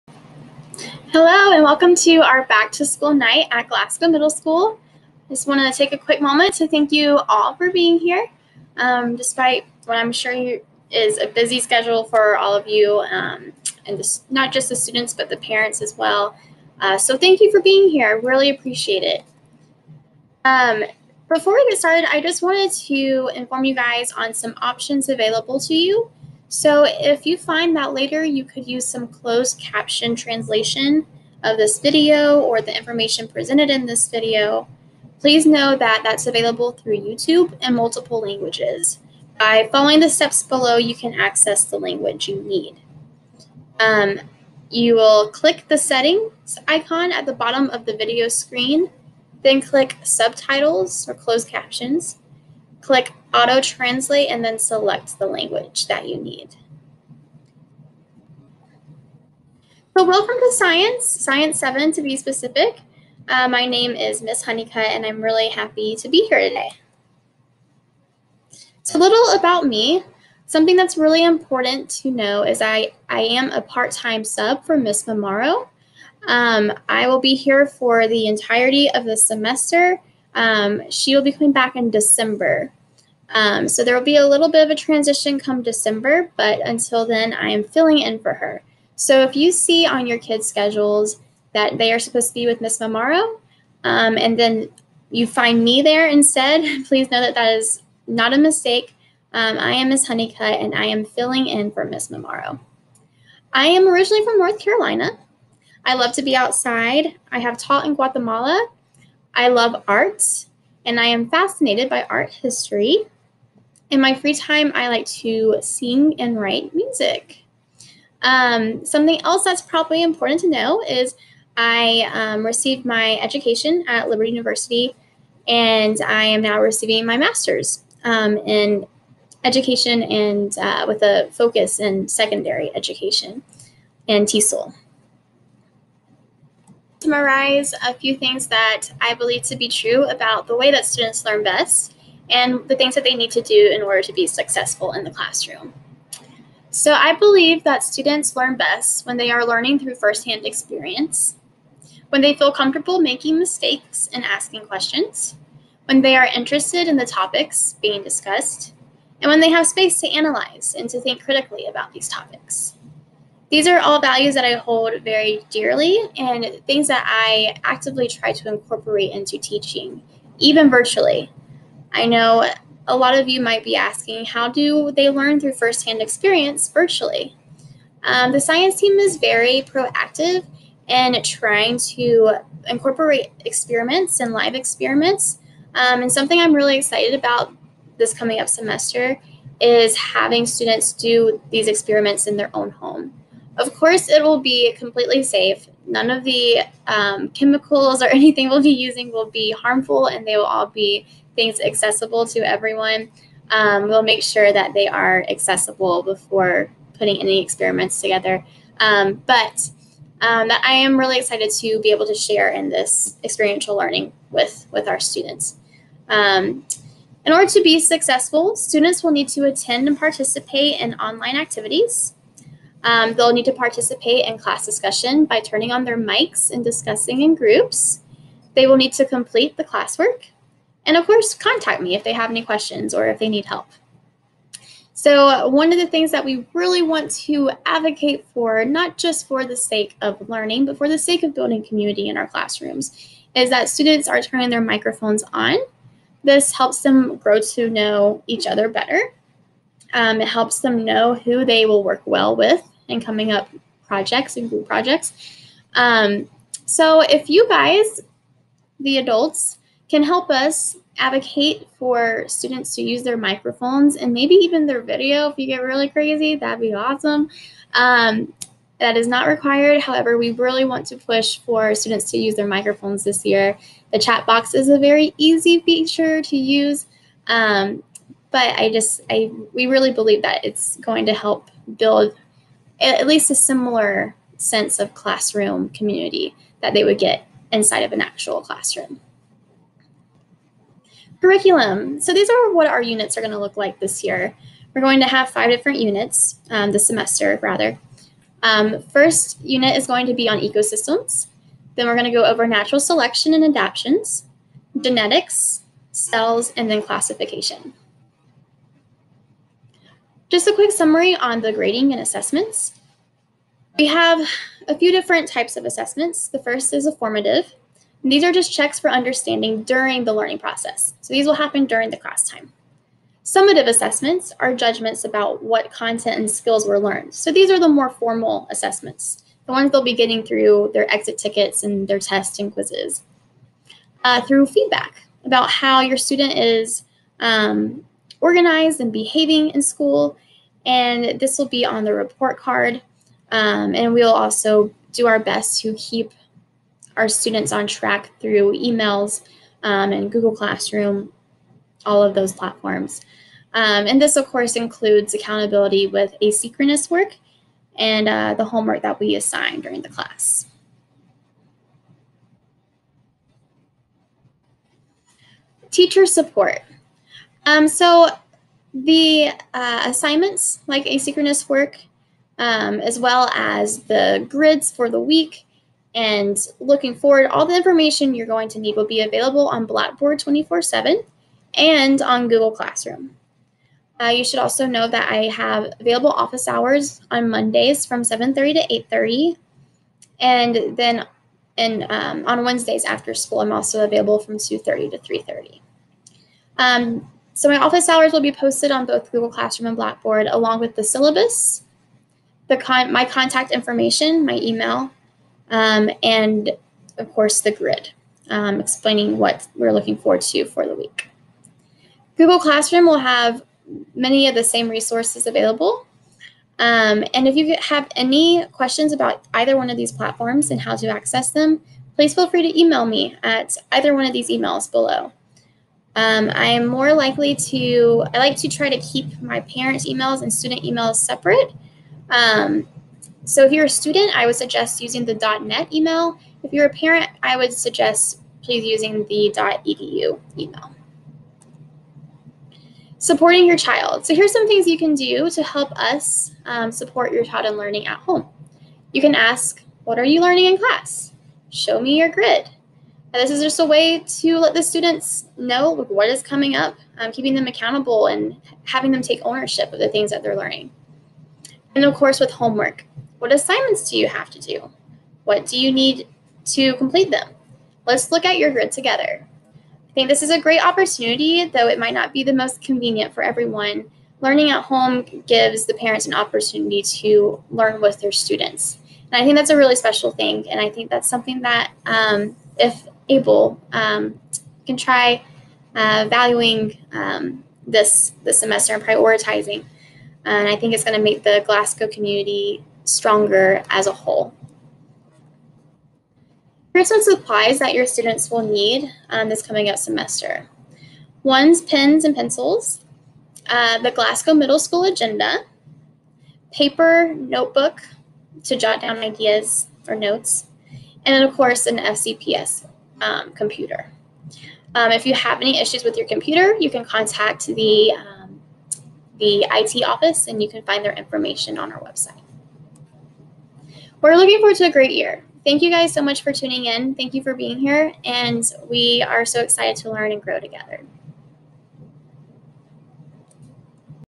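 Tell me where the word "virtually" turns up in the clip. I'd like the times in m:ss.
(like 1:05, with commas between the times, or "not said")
2:50, 2:56.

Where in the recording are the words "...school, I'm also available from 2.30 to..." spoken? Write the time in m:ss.
6:33.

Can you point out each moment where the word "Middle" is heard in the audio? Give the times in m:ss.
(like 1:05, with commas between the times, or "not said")
0:04, 8:24.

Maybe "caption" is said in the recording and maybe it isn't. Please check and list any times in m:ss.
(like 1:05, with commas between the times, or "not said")
0:29, 0:51.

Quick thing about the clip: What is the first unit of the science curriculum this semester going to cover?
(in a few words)
ecosystems.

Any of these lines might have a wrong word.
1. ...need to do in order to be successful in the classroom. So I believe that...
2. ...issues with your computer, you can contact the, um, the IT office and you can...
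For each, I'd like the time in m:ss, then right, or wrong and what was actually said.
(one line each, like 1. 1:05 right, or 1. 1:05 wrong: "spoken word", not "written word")
1. 2:23 right
2. 8:35 right.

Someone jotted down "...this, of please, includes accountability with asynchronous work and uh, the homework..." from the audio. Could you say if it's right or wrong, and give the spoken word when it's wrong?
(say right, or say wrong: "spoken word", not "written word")
wrong: "course", not "please".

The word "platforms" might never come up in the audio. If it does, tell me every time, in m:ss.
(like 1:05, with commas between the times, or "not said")
5:52, 6:59.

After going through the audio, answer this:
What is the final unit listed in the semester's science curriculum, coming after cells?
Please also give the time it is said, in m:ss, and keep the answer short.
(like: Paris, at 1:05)
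classification, at 5:06.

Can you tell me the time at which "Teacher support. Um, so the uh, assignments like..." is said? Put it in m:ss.
6:05.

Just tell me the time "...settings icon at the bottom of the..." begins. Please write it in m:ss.
0:45.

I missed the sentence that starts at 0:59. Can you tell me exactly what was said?
So welcome to Science, Science 7 to be specific.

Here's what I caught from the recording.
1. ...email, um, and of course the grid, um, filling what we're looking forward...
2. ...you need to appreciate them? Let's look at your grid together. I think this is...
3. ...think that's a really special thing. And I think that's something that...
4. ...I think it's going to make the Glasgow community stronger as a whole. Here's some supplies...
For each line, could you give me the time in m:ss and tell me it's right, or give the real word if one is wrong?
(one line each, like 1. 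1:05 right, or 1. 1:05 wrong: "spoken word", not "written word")
1. 6:44 wrong: "explaining", not "filling"
2. 7:45 wrong: "complete", not "appreciate"
3. 7:59 right
4. 8:10 right.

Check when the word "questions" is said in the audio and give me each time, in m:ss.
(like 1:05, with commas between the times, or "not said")
2:34, 3:52, 6:58.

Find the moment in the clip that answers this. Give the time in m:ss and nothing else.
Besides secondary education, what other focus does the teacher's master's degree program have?
2:14.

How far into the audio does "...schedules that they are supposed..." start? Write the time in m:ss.
1:30.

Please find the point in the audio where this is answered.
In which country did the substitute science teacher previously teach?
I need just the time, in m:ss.
1:47.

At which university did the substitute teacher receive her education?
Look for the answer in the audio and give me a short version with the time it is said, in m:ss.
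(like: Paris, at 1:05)
Liberty University, at 2:04.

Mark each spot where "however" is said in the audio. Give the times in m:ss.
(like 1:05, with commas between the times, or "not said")
4:29.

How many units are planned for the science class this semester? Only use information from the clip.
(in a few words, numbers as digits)
5.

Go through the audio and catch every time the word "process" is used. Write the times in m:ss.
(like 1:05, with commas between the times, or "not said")
5:20.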